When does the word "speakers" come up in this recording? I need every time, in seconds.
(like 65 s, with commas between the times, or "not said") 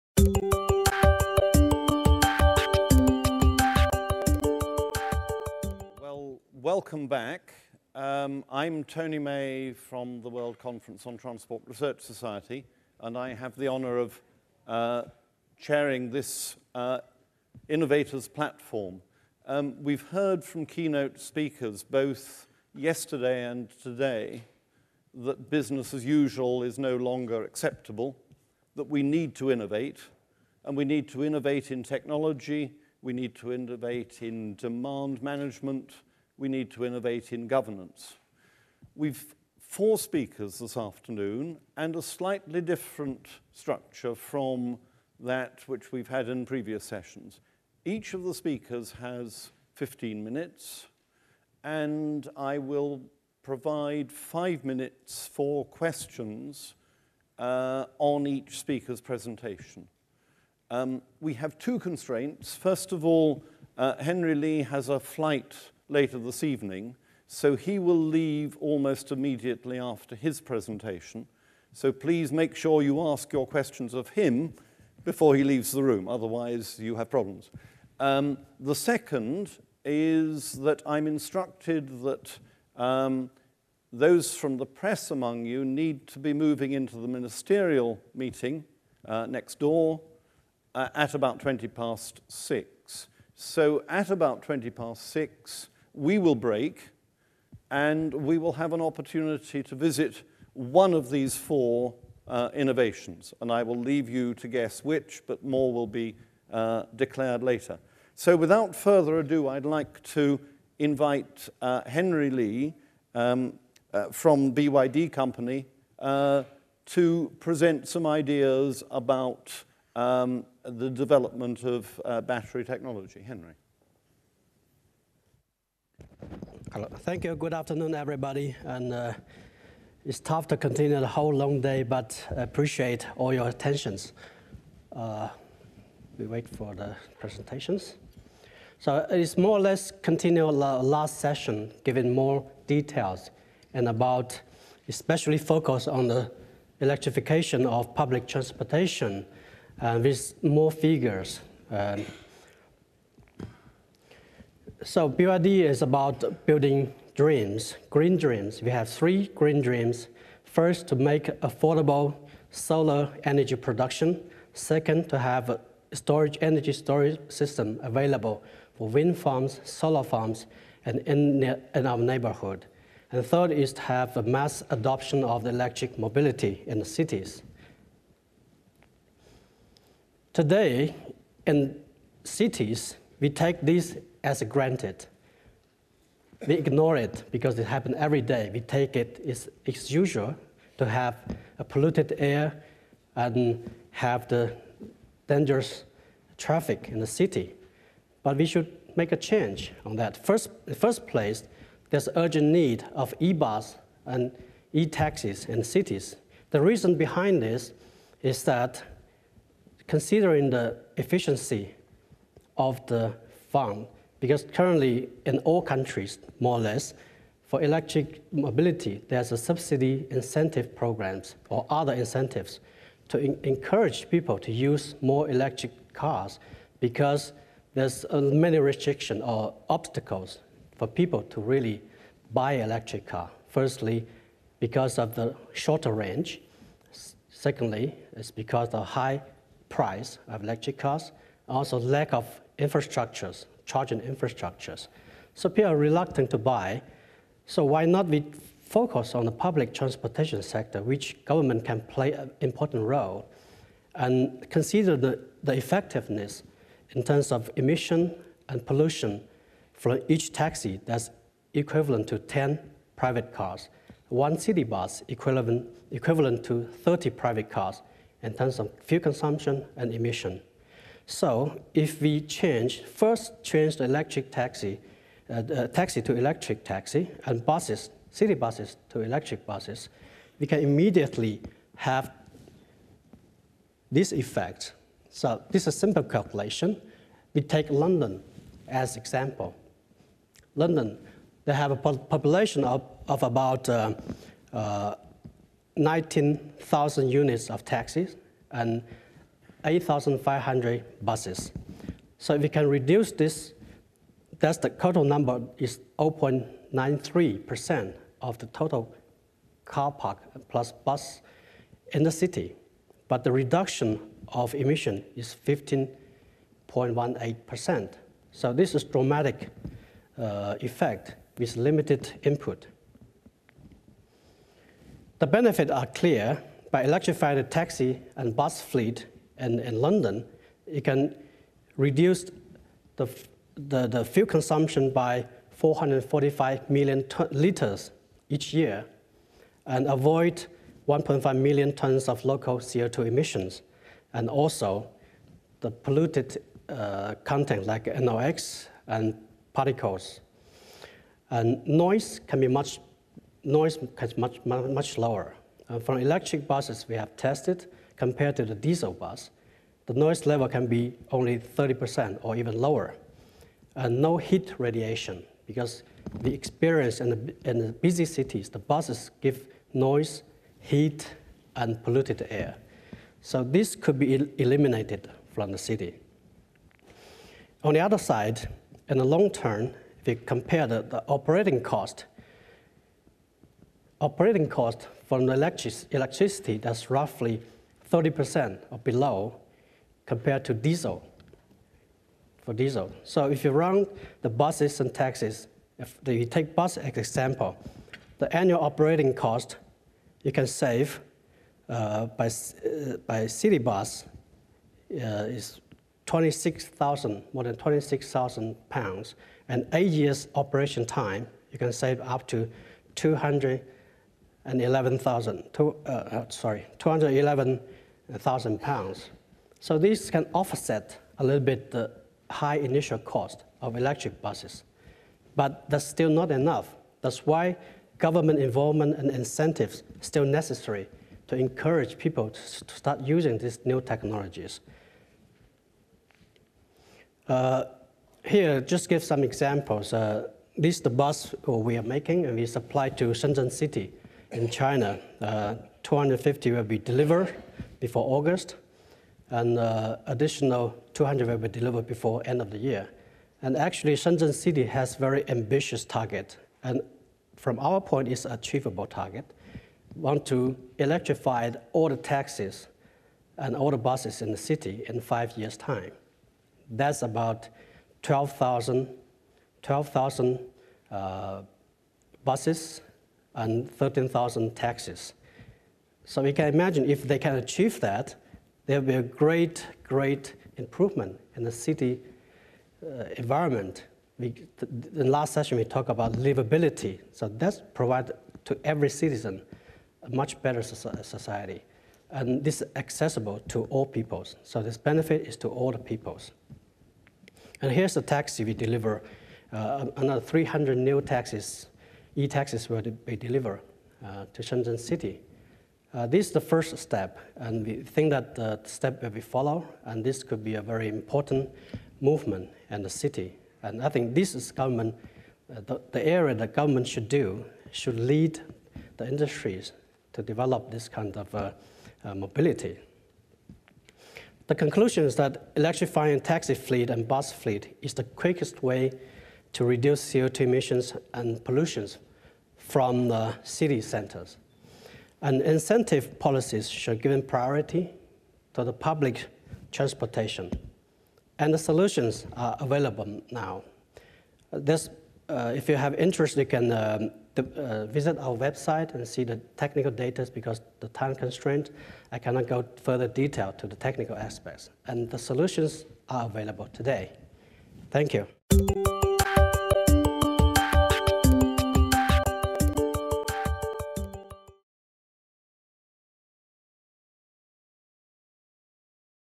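21 s, 39 s, 48 s, 58 s.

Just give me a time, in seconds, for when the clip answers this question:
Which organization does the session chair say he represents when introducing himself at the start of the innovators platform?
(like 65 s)
10 s.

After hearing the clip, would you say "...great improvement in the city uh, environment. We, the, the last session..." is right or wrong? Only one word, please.
right.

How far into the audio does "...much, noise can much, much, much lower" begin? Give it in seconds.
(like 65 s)
352 s.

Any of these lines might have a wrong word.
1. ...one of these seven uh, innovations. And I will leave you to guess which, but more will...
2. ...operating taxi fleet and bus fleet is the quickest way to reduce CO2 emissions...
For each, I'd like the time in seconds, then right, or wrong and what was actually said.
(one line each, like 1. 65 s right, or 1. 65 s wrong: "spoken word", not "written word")
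1. 100 s wrong: "four", not "seven"
2. 525 s wrong: "electrifying", not "operating".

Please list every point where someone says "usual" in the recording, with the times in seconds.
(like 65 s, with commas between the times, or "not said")
26 s, 189 s.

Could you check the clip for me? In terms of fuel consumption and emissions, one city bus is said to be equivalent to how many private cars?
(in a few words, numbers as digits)
30.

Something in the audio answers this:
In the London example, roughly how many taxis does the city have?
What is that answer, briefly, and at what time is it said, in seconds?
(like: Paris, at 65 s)
19,000, at 295 s.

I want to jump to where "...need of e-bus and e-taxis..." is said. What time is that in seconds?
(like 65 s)
202 s.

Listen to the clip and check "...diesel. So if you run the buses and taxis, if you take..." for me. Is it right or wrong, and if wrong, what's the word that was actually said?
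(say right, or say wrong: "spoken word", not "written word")
right.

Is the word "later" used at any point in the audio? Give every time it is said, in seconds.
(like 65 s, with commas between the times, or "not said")
65 s, 107 s.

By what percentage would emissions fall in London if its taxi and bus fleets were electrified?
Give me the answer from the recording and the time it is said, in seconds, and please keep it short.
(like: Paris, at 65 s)
15.18%, at 315 s.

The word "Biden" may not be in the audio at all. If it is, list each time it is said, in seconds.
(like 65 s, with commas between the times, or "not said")
not said.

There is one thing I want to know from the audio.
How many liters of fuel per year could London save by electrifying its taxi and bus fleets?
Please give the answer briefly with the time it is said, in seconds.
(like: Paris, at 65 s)
445 million liters, at 335 s.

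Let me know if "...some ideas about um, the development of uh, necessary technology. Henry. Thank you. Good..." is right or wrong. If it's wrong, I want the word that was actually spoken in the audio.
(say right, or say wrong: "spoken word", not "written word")
wrong: "battery", not "necessary".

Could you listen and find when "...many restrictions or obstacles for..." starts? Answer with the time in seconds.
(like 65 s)
228 s.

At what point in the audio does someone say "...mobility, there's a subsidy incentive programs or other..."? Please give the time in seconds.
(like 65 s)
218 s.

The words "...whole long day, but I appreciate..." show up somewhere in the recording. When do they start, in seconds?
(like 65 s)
131 s.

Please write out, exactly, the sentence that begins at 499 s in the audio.
Uh, another 300 new taxis, e-taxis will be delivered uh, to Shenzhen City.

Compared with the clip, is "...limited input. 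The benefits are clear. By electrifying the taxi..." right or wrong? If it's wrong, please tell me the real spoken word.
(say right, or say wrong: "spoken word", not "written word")
right.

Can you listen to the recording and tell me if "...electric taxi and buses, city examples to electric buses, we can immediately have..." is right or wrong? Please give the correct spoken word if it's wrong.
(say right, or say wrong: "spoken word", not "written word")
wrong: "buses", not "examples".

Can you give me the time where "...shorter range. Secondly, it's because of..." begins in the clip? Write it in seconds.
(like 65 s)
235 s.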